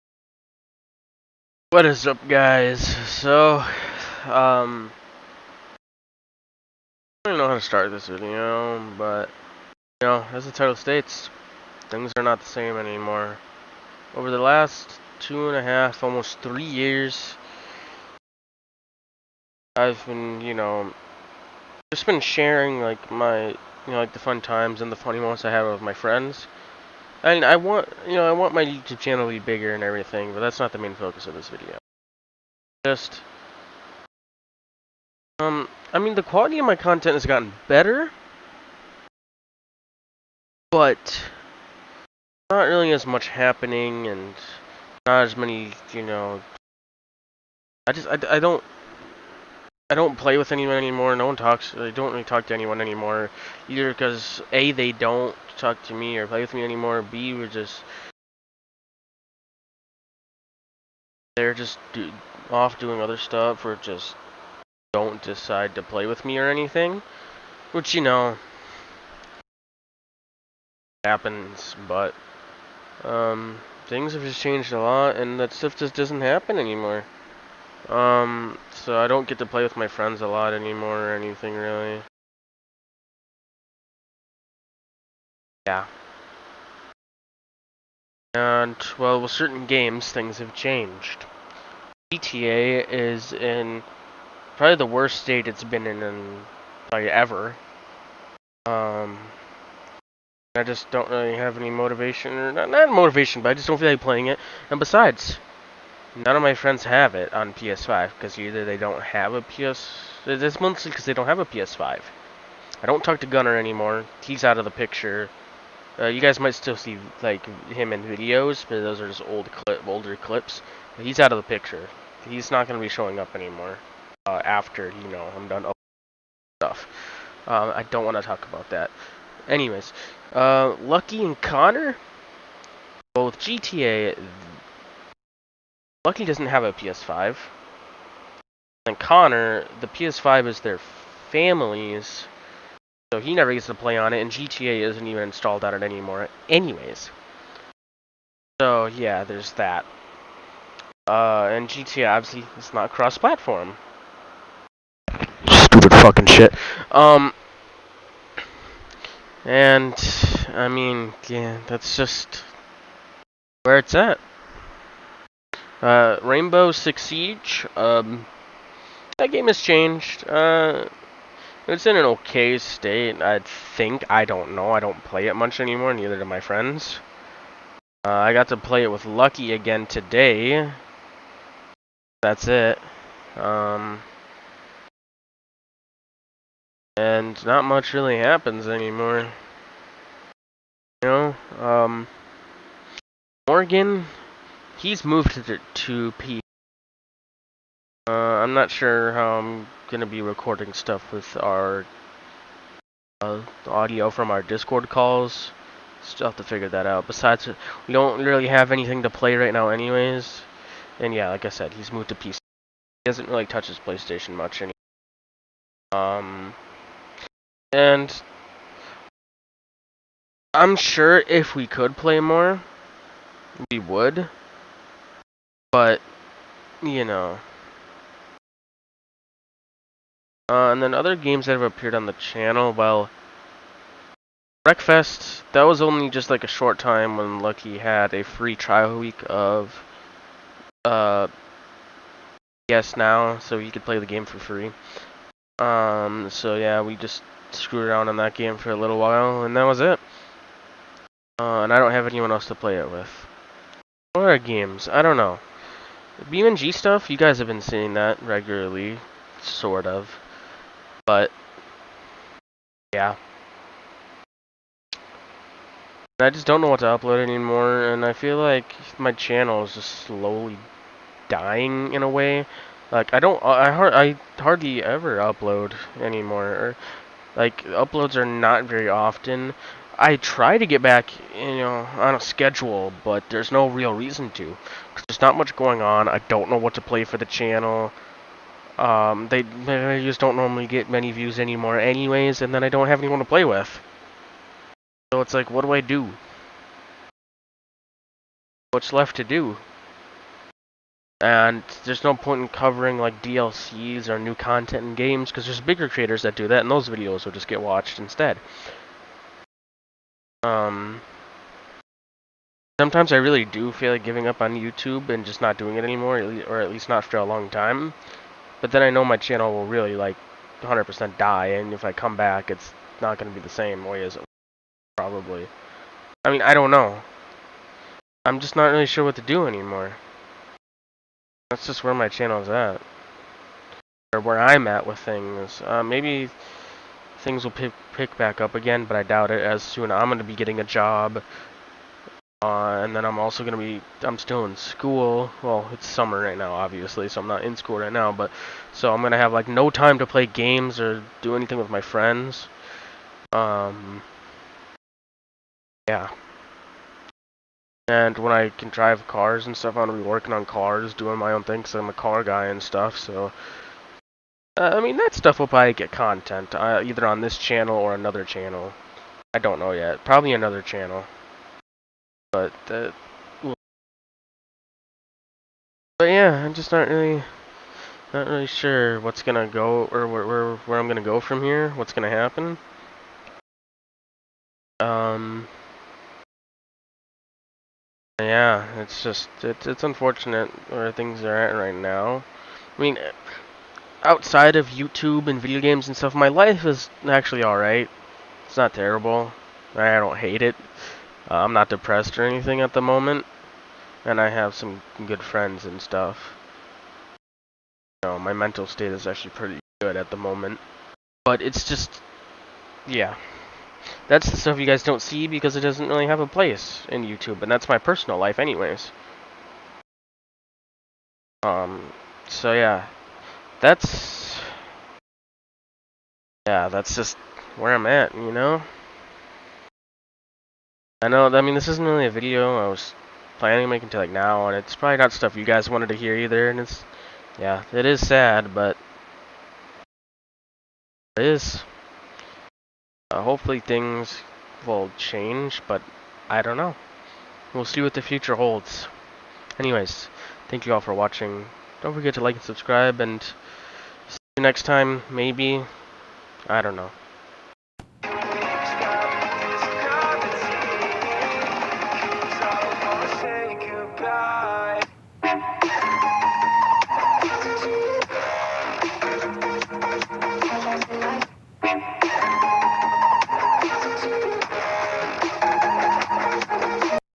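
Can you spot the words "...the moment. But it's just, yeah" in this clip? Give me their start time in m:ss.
6:50.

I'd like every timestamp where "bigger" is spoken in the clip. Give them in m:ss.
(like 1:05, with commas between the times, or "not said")
0:29, 5:05.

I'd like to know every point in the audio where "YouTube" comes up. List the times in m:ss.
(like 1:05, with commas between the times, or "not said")
0:28, 5:14, 6:34, 6:57.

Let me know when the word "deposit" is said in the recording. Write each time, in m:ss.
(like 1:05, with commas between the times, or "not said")
not said.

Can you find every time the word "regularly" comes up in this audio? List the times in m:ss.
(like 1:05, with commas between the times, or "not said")
4:18.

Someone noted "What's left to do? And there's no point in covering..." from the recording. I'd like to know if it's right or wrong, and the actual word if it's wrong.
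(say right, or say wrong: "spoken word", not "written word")
right.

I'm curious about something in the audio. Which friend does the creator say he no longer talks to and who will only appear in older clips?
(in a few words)
Gunner.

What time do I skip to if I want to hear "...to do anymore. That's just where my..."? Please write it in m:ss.
5:29.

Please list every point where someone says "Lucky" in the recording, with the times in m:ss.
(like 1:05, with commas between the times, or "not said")
2:10, 2:16, 2:59, 3:57.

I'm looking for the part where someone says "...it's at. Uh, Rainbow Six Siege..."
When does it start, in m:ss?
2:43.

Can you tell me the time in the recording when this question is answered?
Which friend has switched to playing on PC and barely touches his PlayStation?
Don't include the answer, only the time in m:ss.
3:13.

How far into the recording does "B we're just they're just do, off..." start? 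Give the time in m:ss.
0:57.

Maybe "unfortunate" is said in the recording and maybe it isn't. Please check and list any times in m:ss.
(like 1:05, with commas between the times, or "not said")
6:29.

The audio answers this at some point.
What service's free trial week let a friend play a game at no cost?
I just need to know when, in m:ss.
4:02.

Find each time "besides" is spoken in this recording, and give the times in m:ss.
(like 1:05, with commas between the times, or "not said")
1:44, 3:27.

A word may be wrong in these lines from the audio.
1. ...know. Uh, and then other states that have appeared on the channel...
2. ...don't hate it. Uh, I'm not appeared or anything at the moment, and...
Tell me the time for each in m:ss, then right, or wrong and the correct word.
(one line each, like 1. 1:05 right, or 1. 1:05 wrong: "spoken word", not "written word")
1. 3:47 wrong: "games", not "states"
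2. 6:39 wrong: "depressed", not "appeared".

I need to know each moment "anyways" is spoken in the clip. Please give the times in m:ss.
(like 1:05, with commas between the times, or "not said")
2:09, 2:26, 3:29, 4:51, 6:58, 7:29.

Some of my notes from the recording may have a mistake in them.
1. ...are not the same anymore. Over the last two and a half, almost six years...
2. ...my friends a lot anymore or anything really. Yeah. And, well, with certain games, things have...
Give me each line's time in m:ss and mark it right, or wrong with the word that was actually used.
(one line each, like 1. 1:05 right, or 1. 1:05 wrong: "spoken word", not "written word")
1. 0:12 wrong: "three", not "six"
2. 1:19 right.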